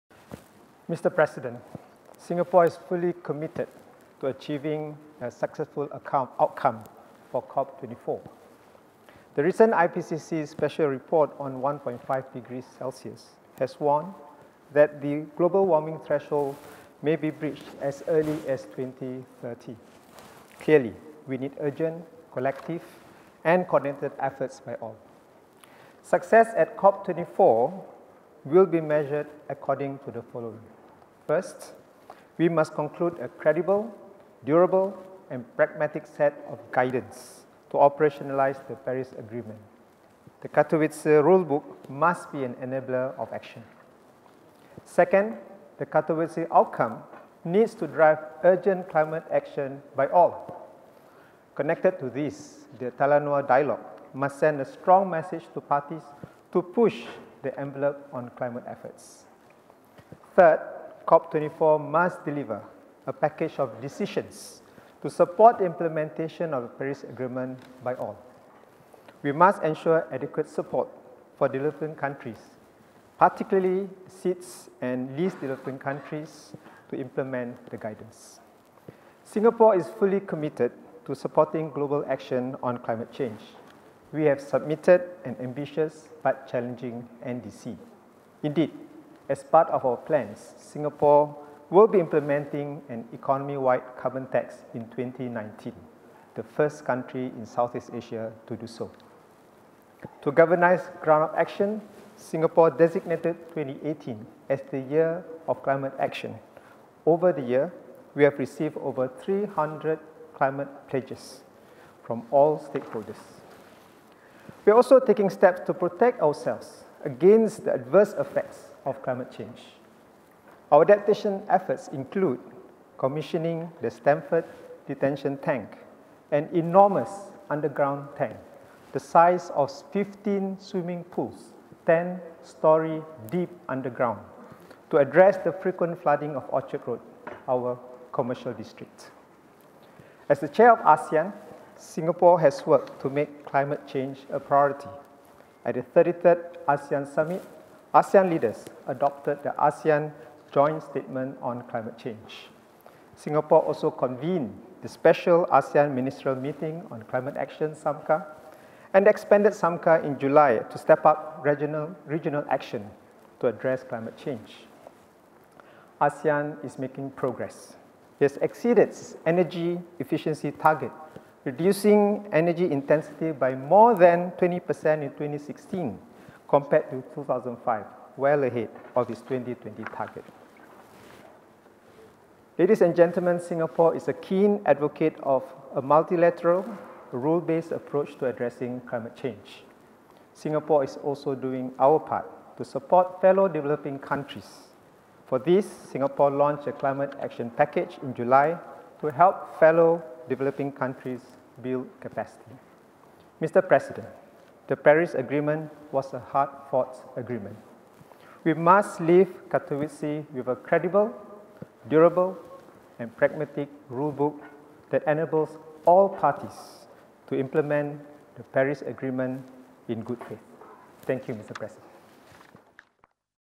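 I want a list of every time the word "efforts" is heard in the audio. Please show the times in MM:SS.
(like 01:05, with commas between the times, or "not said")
00:24, 00:58, 02:01.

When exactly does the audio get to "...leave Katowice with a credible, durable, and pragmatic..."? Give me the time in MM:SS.
03:29.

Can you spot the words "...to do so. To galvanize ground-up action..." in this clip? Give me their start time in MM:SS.
01:38.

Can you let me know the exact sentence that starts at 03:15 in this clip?
For this, Singapore launched a climate action package in July to help fellow developing countries build capacity.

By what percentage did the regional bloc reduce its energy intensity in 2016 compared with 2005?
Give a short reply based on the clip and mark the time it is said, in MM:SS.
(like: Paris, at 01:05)
More than 20%, at 02:53.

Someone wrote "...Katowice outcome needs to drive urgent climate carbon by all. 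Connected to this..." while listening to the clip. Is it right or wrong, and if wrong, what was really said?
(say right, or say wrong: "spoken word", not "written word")
wrong: "action", not "carbon".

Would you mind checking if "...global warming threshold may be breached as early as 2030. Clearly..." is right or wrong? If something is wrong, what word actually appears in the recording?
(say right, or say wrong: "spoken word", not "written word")
right.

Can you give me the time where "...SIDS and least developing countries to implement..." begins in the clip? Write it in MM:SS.
01:14.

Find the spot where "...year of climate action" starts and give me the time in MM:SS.
01:44.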